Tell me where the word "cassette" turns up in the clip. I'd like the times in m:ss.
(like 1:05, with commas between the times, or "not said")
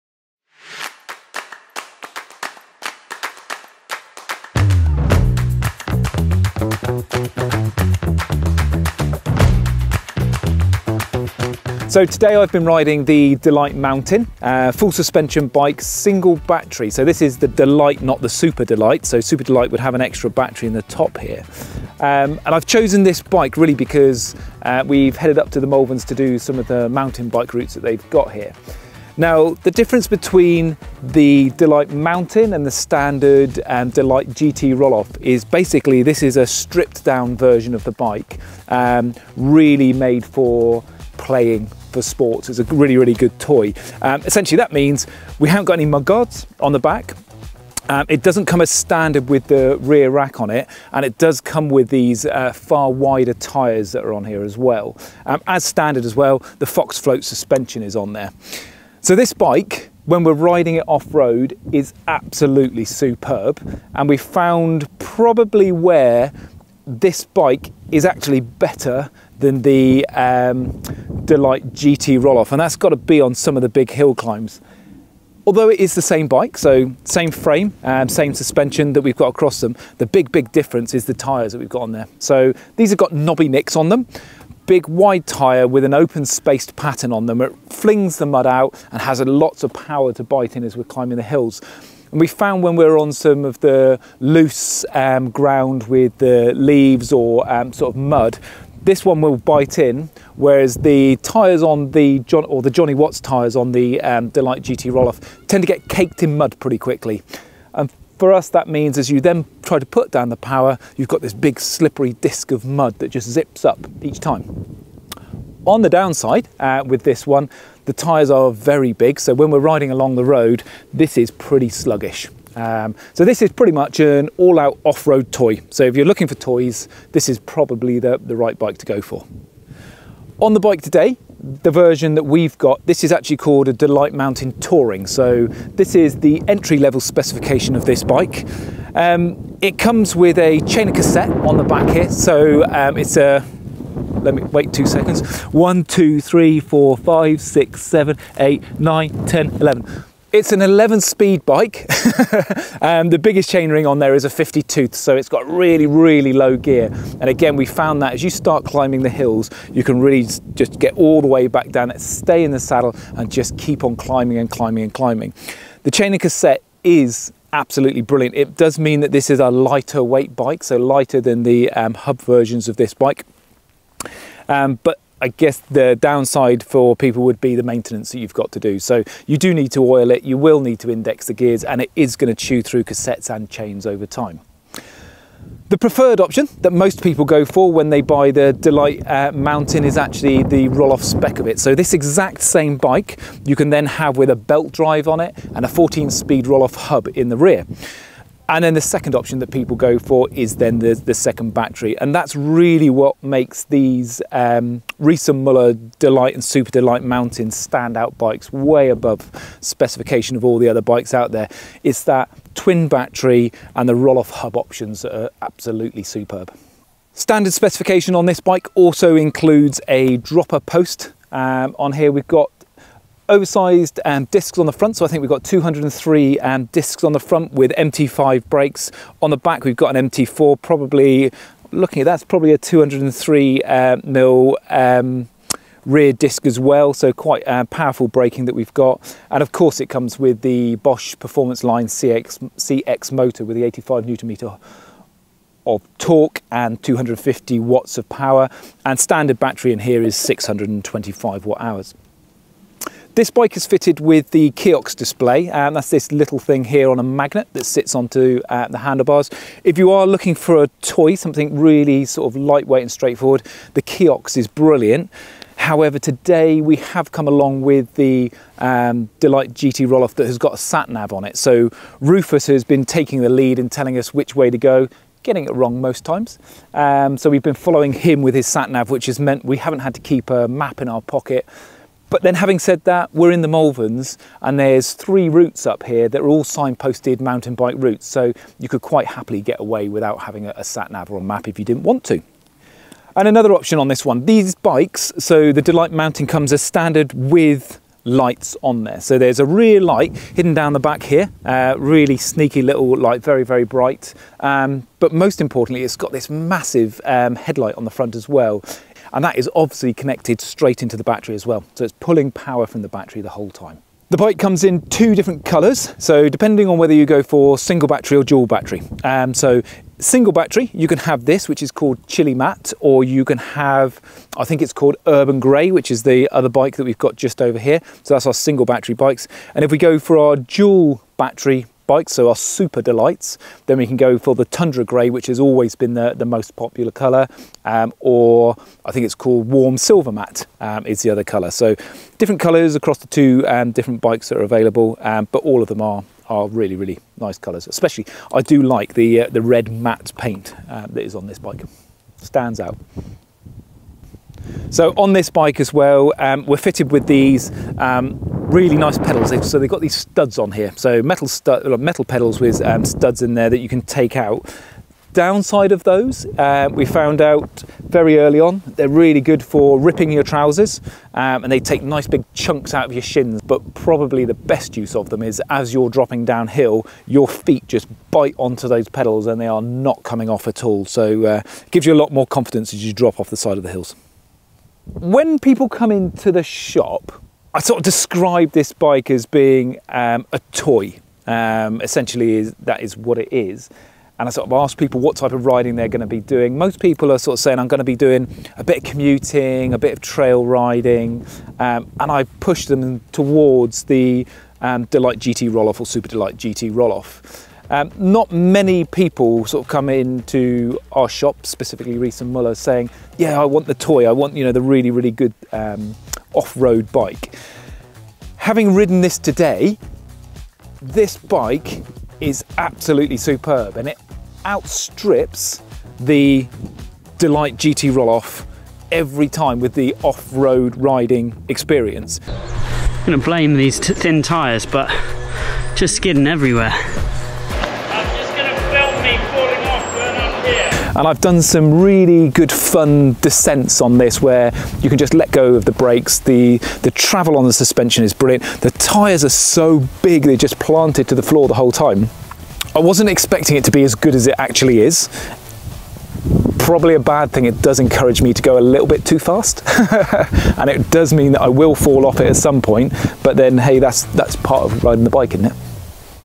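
2:20, 2:46, 3:02.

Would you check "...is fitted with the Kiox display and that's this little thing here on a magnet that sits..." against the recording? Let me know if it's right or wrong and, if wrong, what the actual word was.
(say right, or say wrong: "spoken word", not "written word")
right.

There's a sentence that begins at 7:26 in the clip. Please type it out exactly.
The, the travel on the suspension is brilliant.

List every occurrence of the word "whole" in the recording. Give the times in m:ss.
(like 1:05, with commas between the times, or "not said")
5:13, 7:31.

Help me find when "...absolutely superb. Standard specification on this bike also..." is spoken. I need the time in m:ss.
3:35.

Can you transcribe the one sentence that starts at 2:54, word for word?
Um, but I guess the downside for people would be the maintenance that you've got to do.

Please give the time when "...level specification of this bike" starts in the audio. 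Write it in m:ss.
2:16.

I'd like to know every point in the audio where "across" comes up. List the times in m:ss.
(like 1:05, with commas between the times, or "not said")
1:19, 5:42.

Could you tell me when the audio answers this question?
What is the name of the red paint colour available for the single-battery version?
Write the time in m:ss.
5:22.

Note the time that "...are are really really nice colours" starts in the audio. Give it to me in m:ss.
5:45.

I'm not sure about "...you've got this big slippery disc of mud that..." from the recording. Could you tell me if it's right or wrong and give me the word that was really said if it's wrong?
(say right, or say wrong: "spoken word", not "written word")
right.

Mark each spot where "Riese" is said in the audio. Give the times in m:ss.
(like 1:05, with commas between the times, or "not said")
3:24, 6:51.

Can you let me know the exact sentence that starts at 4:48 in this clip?
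So you could quite happily get away without having a, sat nav or a map if you didn't want to.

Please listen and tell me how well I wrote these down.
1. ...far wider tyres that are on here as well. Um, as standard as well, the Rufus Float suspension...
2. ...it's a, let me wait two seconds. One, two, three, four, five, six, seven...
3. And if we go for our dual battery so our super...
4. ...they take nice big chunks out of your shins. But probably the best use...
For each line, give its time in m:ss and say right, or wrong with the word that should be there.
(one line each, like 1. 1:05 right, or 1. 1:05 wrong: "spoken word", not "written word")
1. 0:52 wrong: "Fox", not "Rufus"
2. 2:22 right
3. 5:29 right
4. 6:11 right.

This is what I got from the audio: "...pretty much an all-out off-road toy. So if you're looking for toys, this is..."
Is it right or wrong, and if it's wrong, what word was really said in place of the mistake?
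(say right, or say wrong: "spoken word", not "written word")
right.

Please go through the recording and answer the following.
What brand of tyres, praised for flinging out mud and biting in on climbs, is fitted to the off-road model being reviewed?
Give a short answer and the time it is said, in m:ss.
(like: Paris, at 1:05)
Nobby Nics, at 1:23.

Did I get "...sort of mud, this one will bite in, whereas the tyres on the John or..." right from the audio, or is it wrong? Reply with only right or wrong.
right.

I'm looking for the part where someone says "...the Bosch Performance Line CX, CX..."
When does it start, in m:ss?
4:00.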